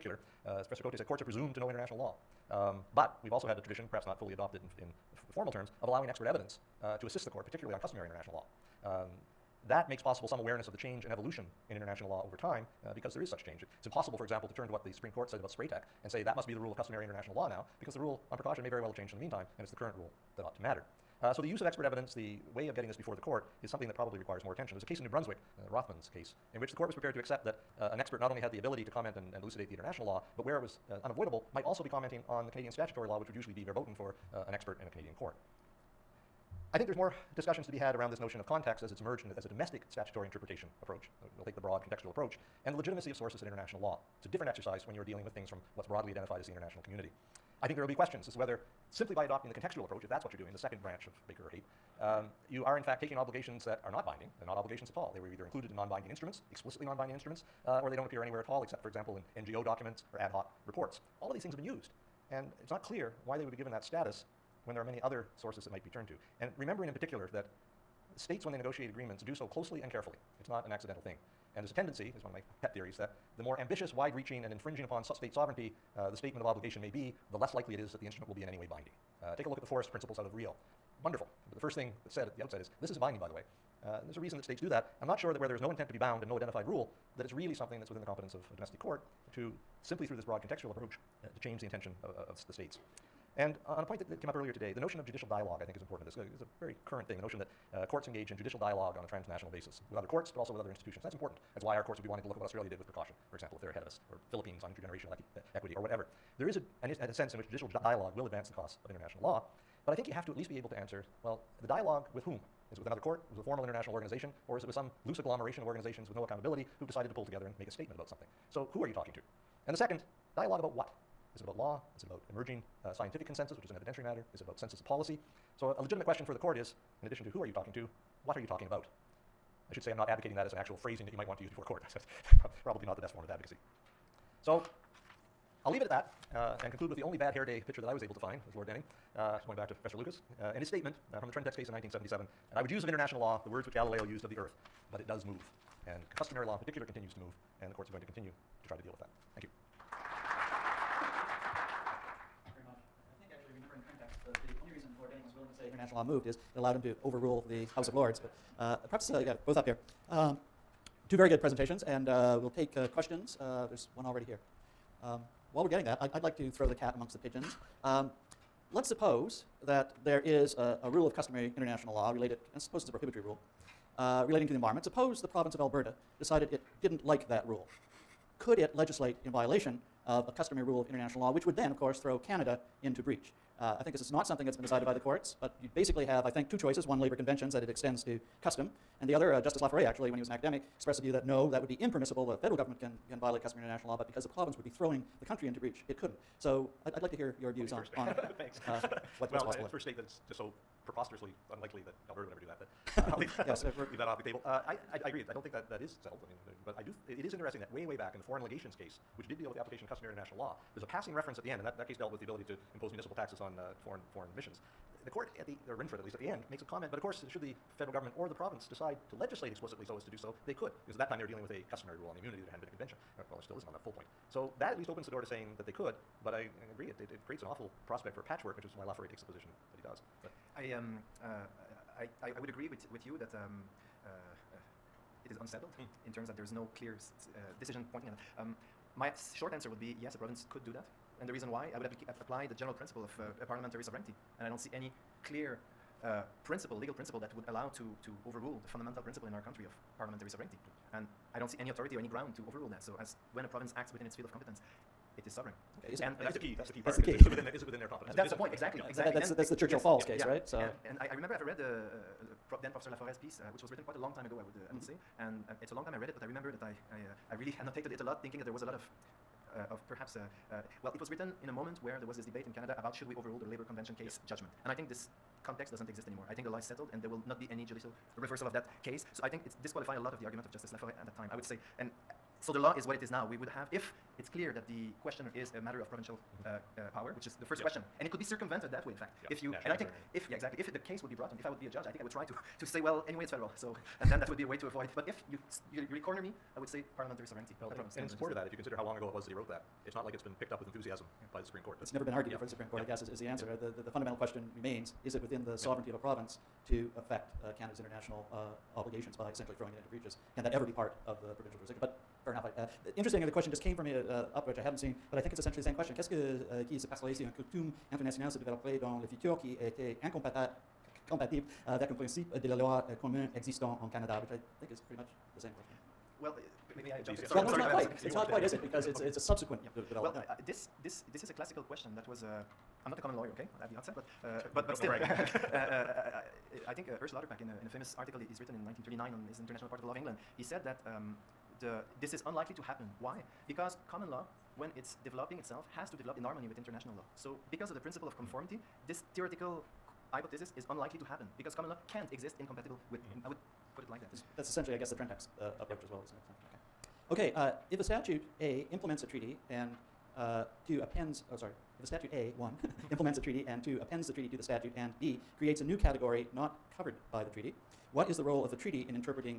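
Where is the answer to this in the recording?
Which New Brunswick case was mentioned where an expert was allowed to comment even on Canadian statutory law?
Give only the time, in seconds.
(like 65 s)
25 s.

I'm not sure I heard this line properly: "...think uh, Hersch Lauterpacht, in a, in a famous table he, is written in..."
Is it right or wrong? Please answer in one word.
wrong.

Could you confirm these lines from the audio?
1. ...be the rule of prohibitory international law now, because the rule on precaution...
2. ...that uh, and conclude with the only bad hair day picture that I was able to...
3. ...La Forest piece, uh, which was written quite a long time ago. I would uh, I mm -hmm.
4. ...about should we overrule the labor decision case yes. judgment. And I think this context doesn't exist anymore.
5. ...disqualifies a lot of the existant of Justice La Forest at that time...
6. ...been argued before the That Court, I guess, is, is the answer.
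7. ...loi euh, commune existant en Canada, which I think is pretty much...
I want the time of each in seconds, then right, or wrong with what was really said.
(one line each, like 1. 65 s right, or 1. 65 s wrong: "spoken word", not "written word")
1. 16 s wrong: "customary", not "prohibitory"
2. 135 s right
3. 262 s right
4. 272 s wrong: "convention", not "decision"
5. 279 s wrong: "argument", not "existant"
6. 302 s wrong: "Supreme", not "That"
7. 322 s right.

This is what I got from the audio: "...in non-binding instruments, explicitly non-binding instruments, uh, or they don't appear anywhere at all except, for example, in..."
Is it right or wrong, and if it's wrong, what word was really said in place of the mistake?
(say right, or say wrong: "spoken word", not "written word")
right.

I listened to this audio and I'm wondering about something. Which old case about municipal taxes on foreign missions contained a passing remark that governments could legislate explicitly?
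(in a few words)
the foreign legations case.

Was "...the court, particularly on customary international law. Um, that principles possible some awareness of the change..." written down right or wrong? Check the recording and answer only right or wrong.
wrong.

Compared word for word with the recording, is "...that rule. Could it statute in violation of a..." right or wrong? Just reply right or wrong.
wrong.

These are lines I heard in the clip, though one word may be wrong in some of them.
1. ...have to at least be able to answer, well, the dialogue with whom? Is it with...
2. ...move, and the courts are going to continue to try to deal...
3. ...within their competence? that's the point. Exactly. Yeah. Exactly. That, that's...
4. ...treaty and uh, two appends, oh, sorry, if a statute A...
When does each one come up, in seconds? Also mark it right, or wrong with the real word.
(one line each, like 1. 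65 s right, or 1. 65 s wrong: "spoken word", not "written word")
1. 110 s right
2. 147 s right
3. 257 s right
4. 359 s right.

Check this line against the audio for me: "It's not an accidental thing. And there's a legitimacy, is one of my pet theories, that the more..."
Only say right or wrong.
wrong.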